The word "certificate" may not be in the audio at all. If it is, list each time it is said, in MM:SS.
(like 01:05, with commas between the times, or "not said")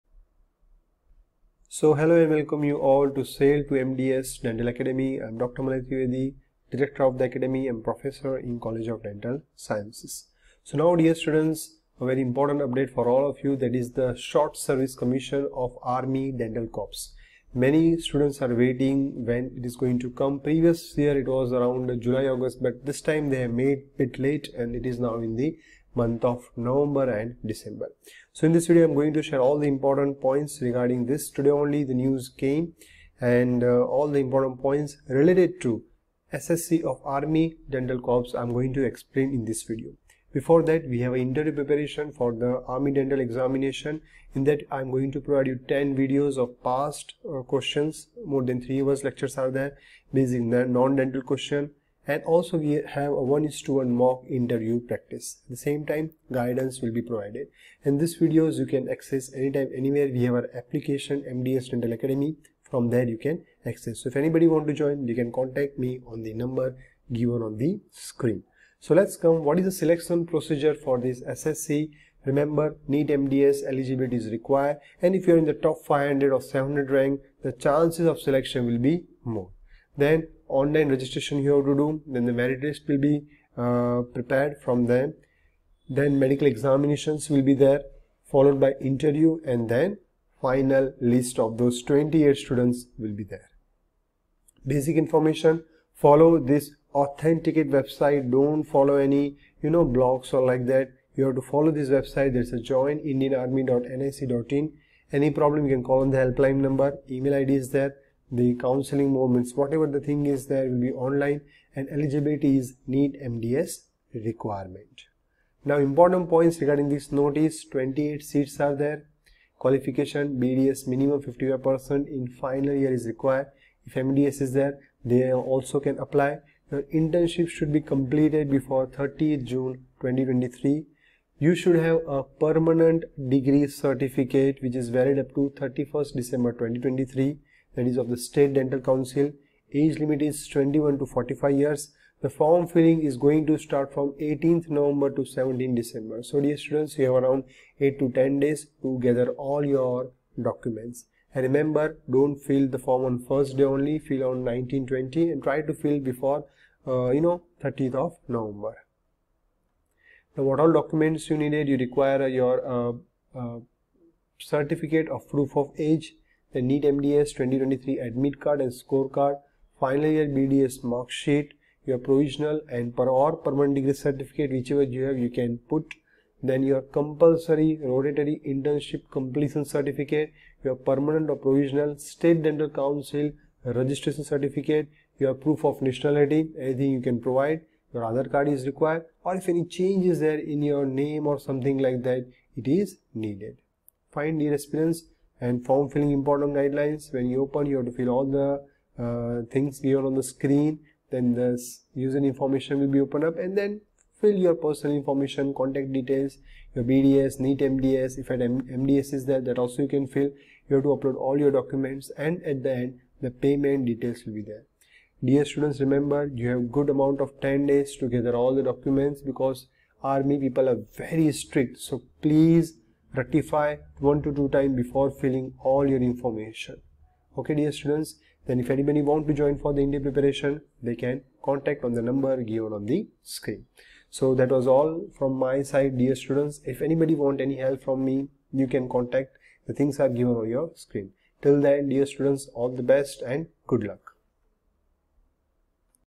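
02:13, 02:44, 02:53, 02:59, 03:04.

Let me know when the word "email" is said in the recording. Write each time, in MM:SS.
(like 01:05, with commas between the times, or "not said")
01:47.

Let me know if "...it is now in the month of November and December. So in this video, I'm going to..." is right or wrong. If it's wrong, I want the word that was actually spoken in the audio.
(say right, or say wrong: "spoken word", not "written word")
right.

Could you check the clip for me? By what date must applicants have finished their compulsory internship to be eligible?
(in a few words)
30th June 2023.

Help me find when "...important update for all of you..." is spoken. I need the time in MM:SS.
00:12.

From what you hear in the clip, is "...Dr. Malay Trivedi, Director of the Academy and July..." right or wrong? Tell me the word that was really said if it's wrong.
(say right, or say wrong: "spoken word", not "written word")
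wrong: "Professor", not "July".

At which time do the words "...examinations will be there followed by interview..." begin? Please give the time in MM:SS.
01:26.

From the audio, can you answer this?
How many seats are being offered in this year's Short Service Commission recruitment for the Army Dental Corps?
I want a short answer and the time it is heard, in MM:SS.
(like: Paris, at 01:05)
28, at 01:57.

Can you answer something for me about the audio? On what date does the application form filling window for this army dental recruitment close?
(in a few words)
17th December.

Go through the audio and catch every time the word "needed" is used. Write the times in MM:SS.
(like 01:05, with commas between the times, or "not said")
02:41, 03:13.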